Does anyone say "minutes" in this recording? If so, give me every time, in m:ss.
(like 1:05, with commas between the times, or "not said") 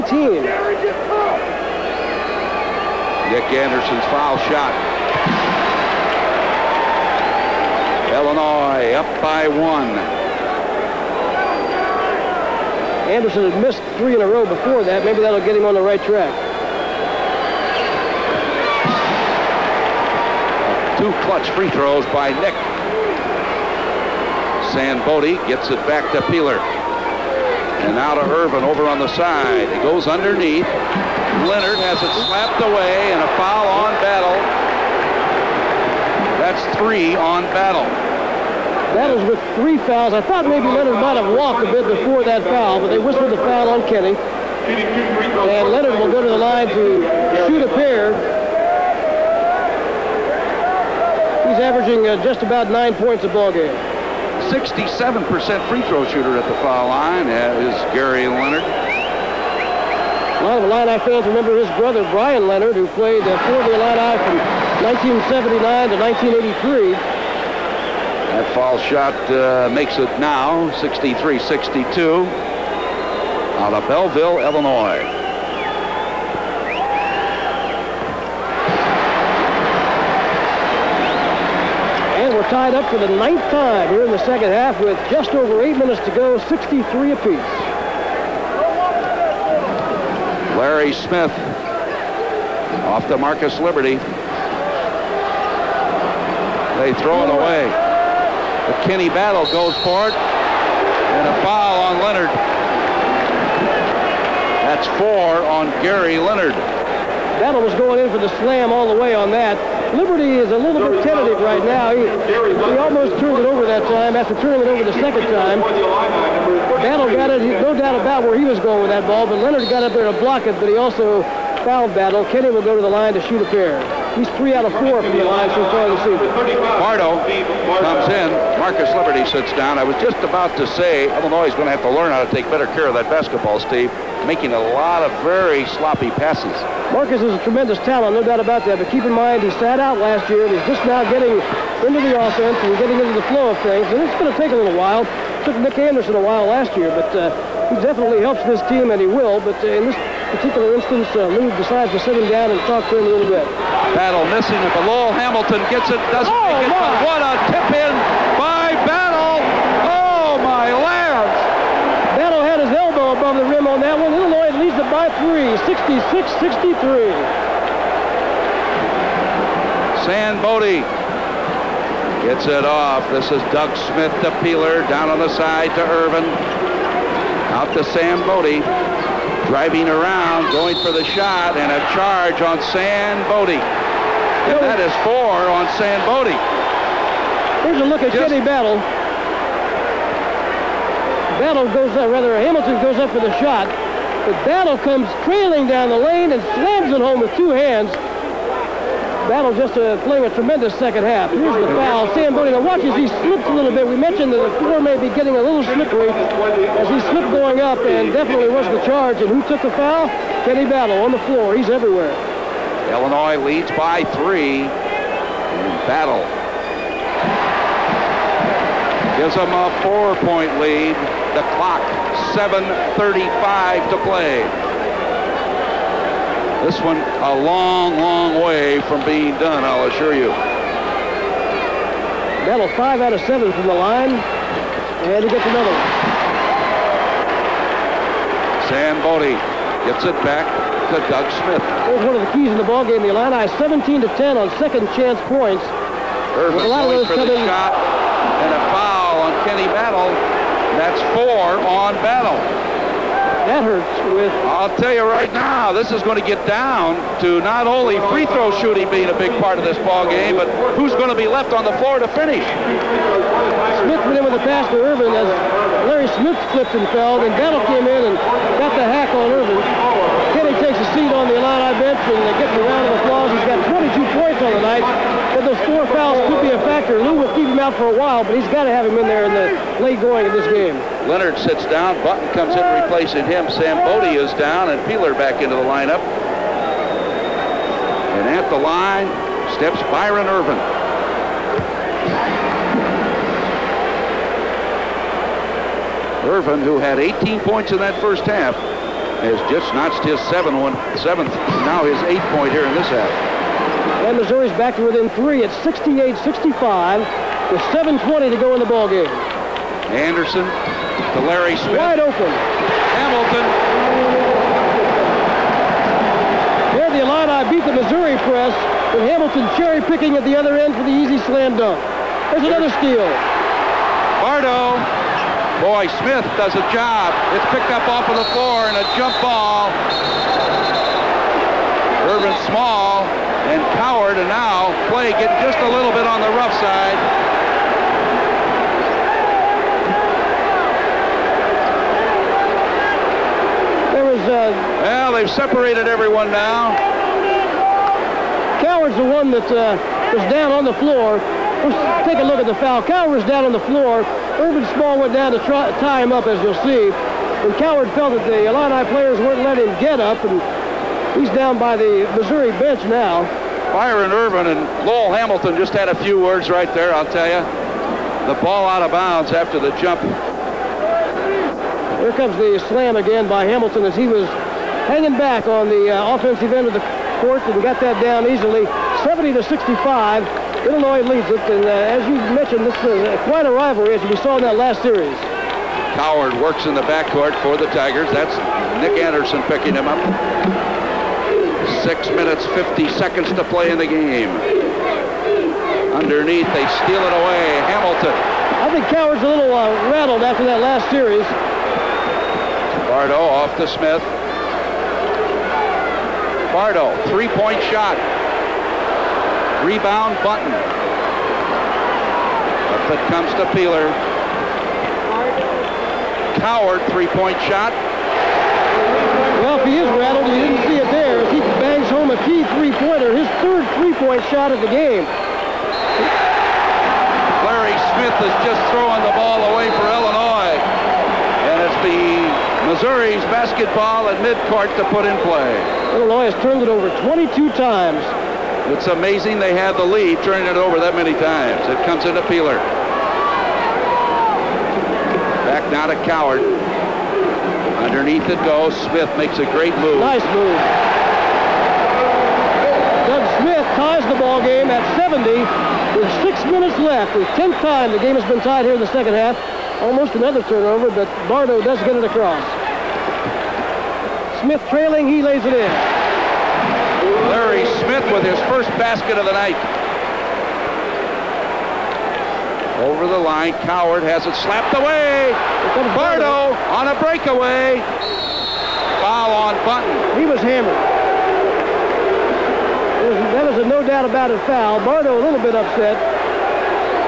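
1:25, 6:32, 7:36.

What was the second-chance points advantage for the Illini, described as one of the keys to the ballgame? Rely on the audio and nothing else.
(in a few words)
17 to 10.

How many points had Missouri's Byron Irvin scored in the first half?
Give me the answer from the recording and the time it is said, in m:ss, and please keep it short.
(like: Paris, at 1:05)
18, at 4:56.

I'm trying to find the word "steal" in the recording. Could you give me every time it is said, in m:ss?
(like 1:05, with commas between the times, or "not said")
5:22, 6:36.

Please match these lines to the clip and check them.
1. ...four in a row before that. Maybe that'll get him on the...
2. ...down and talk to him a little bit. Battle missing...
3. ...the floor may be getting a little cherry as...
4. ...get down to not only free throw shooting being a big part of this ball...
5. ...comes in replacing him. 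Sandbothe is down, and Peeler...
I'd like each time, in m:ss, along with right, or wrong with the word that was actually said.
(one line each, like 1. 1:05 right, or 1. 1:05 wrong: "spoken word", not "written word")
1. 0:13 wrong: "three", not "four"
2. 2:32 right
3. 3:24 wrong: "slippery", not "cherry"
4. 4:16 right
5. 4:42 right.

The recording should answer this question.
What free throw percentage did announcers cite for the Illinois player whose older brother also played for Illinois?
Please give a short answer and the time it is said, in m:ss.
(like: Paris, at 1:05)
67%, at 0:54.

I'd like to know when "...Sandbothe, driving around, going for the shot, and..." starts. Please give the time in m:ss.
2:57.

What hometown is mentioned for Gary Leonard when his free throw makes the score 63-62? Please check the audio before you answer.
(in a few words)
Belleville, Illinois.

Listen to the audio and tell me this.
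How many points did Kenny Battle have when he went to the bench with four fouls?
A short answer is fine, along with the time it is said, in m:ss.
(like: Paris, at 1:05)
22, at 4:33.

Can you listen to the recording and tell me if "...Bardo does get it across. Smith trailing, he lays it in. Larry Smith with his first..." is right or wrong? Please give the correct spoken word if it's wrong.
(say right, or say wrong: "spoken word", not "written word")
right.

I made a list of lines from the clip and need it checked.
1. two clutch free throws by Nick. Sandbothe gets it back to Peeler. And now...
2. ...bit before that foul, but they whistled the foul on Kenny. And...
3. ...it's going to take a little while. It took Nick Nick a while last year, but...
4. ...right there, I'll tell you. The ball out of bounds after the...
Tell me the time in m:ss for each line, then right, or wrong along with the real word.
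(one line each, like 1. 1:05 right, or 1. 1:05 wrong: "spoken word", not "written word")
1. 0:20 right
2. 0:41 right
3. 2:24 wrong: "Anderson", not "Nick"
4. 6:06 right.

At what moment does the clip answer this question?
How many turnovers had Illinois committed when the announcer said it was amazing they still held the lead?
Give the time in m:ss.
7:17.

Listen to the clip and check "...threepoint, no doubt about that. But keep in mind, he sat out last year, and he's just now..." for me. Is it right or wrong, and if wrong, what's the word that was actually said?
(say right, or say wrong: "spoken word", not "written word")
wrong: "talent", not "threepoint".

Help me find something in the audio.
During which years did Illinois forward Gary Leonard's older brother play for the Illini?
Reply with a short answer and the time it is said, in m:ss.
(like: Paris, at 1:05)
1979 to 1983, at 1:05.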